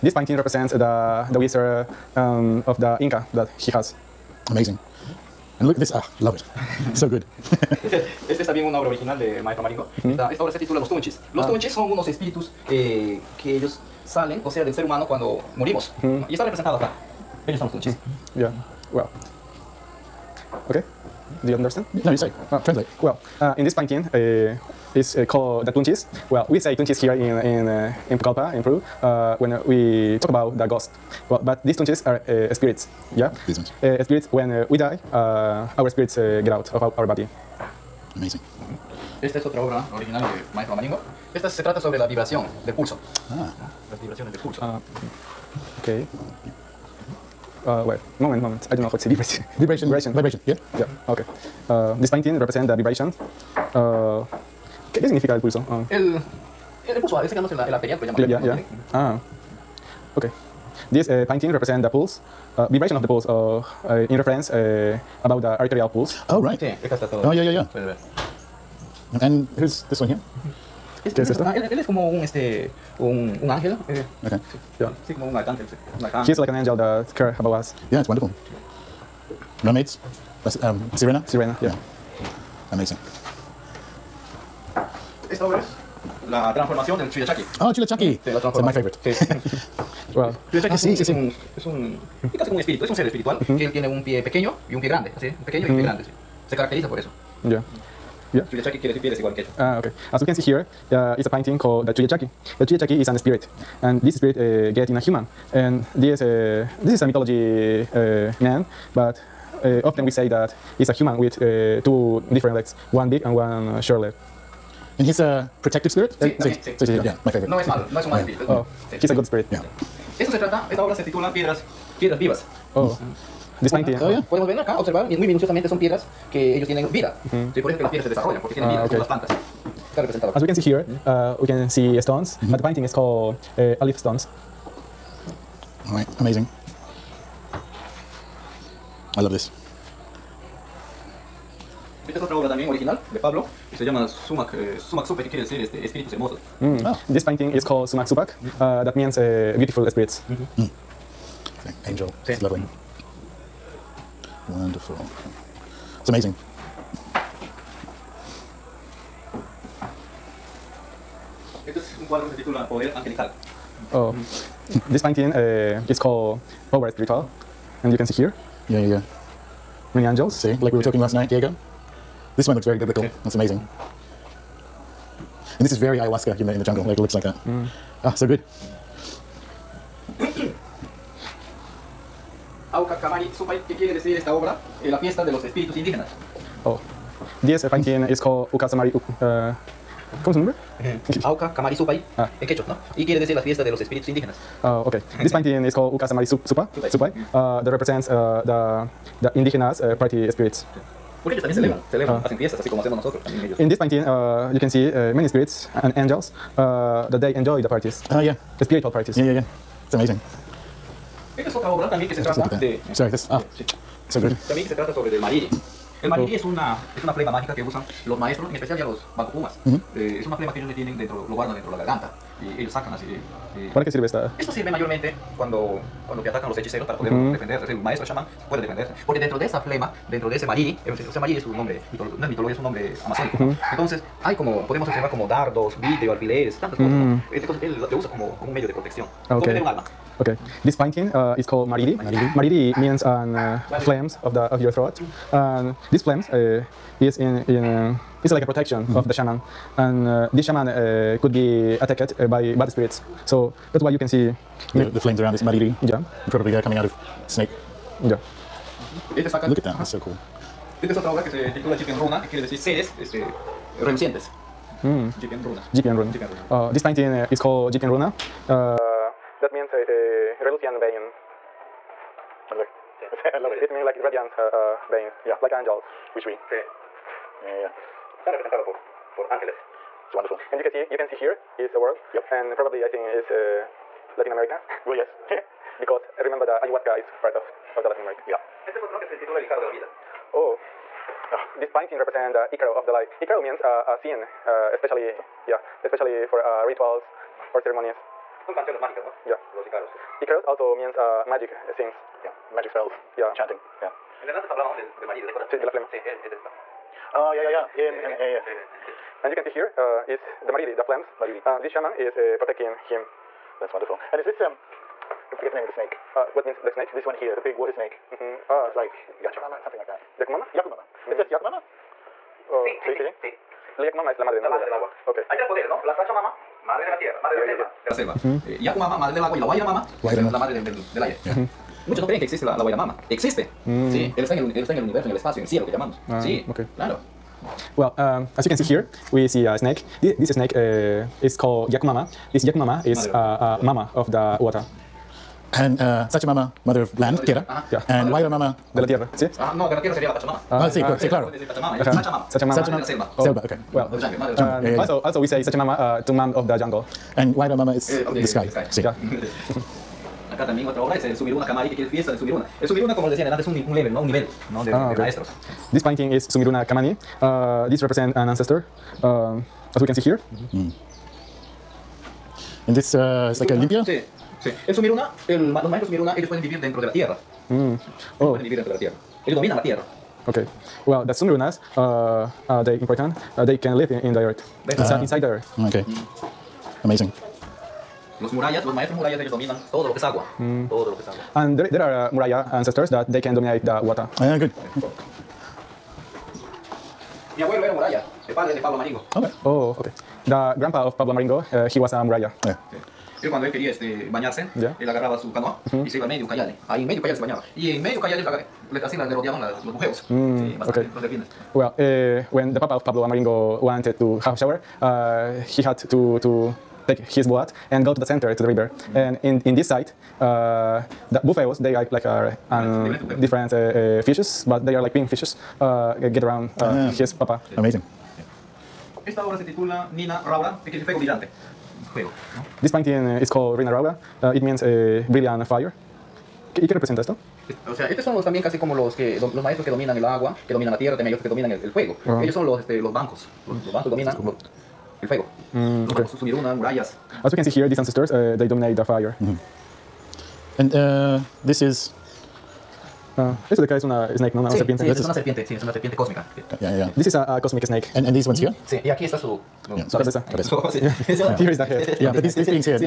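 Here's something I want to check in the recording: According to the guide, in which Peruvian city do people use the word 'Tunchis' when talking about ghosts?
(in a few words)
Pucallpa.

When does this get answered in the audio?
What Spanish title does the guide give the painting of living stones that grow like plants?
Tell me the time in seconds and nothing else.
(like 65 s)
122 s.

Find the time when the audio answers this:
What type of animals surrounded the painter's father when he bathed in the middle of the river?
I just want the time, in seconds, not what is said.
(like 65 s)
410 s.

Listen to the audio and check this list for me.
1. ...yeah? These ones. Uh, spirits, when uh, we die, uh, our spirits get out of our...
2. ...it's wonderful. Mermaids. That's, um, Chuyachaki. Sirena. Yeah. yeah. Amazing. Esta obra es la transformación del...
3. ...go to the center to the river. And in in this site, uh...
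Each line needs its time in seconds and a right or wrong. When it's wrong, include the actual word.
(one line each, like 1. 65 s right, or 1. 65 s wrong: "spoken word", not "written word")
1. 33 s right
2. 78 s wrong: "Sirena", not "Chuyachaki"
3. 417 s right.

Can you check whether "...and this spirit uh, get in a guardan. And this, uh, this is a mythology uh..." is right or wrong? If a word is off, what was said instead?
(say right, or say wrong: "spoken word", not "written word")
wrong: "human", not "guardan".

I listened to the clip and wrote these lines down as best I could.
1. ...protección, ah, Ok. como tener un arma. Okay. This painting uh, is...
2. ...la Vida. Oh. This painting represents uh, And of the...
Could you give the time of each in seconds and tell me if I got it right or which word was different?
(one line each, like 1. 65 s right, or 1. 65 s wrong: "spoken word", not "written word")
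1. 238 s right
2. 289 s wrong: "Icaro", not "And".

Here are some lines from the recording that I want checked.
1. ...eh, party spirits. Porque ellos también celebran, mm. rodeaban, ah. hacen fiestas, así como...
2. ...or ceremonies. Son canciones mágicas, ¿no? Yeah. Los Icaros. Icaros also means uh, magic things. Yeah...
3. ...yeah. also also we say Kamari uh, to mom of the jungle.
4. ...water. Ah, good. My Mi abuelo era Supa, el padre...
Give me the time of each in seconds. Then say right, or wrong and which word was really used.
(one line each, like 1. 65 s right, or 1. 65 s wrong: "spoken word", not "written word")
1. 199 s wrong: "celebran", not "rodeaban"
2. 297 s right
3. 354 s wrong: "Sachamama", not "Kamari"
4. 393 s wrong: "Muraya", not "Supa".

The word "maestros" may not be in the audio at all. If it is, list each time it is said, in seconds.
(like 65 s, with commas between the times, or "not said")
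9 s, 40 s, 218 s, 227 s, 364 s, 375 s, 388 s, 439 s.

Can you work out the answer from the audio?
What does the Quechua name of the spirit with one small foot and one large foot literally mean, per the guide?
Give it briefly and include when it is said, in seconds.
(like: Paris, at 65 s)
pie desigual, at 98 s.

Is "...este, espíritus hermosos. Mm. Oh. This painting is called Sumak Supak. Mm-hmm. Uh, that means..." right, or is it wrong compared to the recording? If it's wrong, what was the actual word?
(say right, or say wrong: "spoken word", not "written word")
right.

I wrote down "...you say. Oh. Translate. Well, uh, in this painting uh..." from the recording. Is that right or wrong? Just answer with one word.
right.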